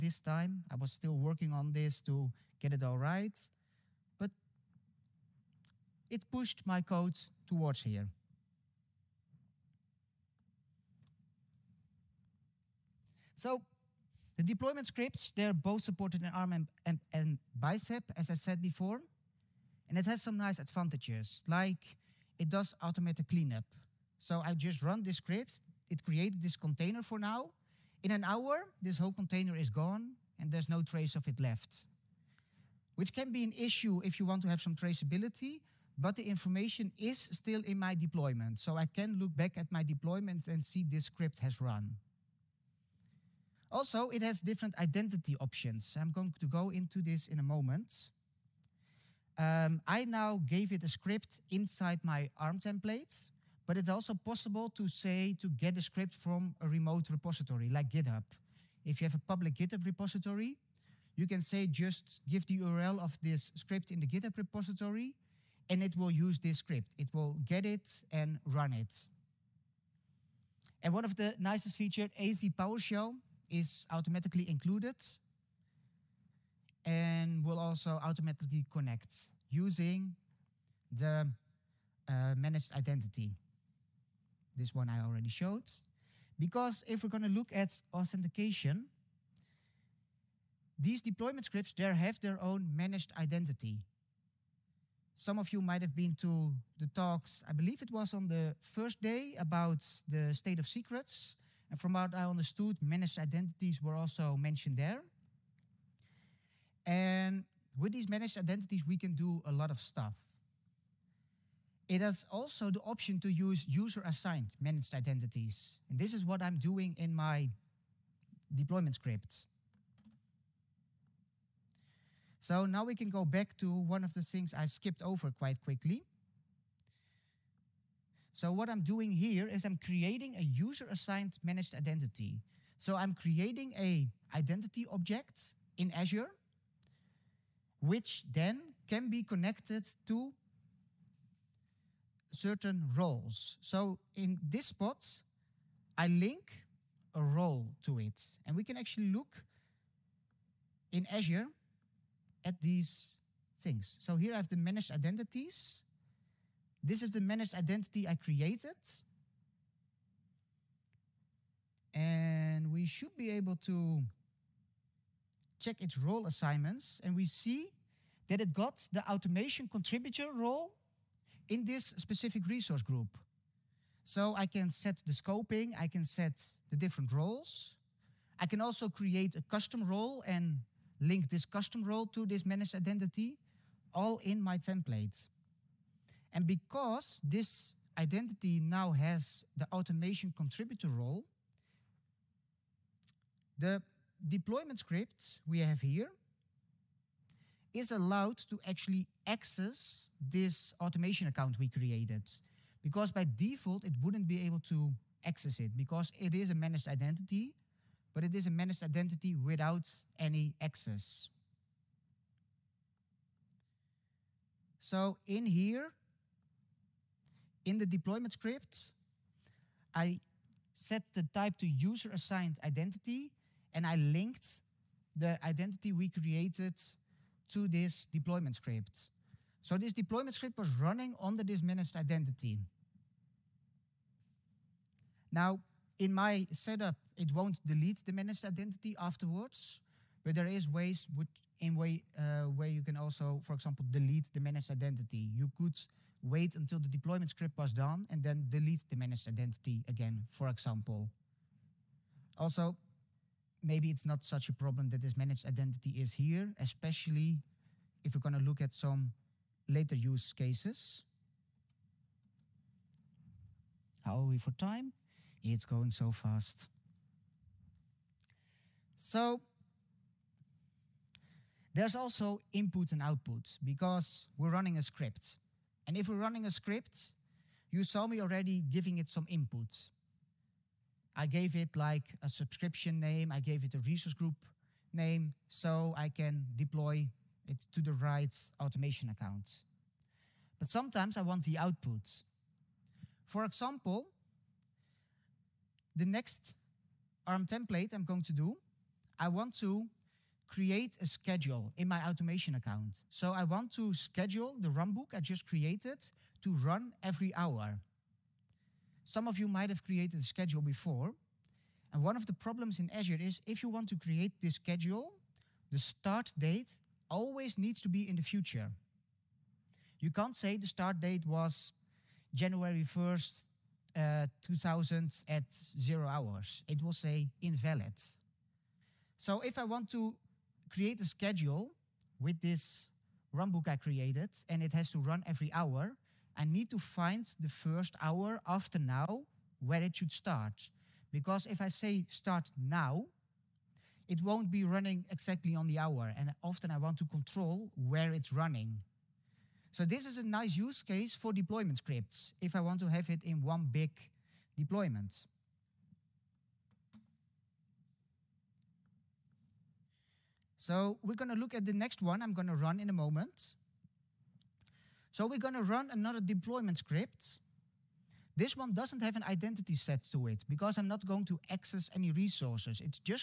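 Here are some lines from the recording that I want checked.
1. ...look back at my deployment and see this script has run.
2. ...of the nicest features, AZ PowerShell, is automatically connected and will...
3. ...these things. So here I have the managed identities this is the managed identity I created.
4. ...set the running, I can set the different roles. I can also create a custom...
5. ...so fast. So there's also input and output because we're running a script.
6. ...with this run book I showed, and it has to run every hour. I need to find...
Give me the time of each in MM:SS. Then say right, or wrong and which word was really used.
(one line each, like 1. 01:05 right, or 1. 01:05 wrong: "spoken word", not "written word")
1. 00:39 right
2. 01:11 wrong: "included", not "connected"
3. 02:32 right
4. 02:54 wrong: "scoping", not "running"
5. 04:25 right
6. 05:32 wrong: "created", not "showed".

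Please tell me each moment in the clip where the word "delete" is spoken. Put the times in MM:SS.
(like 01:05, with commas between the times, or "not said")
03:57, 04:03, 04:08.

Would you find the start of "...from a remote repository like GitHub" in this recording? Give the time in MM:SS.
00:56.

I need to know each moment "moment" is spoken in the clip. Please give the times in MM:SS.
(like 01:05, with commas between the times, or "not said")
00:47, 06:02.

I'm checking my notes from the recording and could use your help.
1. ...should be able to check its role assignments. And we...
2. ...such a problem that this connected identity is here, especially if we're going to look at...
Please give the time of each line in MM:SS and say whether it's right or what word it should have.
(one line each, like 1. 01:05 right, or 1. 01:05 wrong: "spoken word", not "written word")
1. 02:42 right
2. 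04:14 wrong: "managed", not "connected".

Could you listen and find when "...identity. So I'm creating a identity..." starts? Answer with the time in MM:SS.
02:11.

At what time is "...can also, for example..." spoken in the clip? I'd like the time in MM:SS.
04:02.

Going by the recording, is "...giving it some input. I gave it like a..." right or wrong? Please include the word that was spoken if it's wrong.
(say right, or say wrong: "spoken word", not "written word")
right.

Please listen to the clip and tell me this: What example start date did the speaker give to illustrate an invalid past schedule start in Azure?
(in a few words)
January 1st, 2000.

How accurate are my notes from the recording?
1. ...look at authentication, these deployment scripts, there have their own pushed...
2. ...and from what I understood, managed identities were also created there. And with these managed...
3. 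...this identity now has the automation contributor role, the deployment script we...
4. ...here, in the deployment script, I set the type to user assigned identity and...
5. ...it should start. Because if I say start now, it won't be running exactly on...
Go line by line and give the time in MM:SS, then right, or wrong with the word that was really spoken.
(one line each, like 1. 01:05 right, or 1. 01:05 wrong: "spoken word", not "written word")
1. 01:27 wrong: "managed", not "pushed"
2. 01:41 wrong: "mentioned", not "created"
3. 03:07 right
4. 03:35 right
5. 05:39 right.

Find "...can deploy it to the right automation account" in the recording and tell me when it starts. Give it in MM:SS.
04:46.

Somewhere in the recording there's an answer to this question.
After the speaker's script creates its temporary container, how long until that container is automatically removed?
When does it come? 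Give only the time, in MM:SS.
00:28.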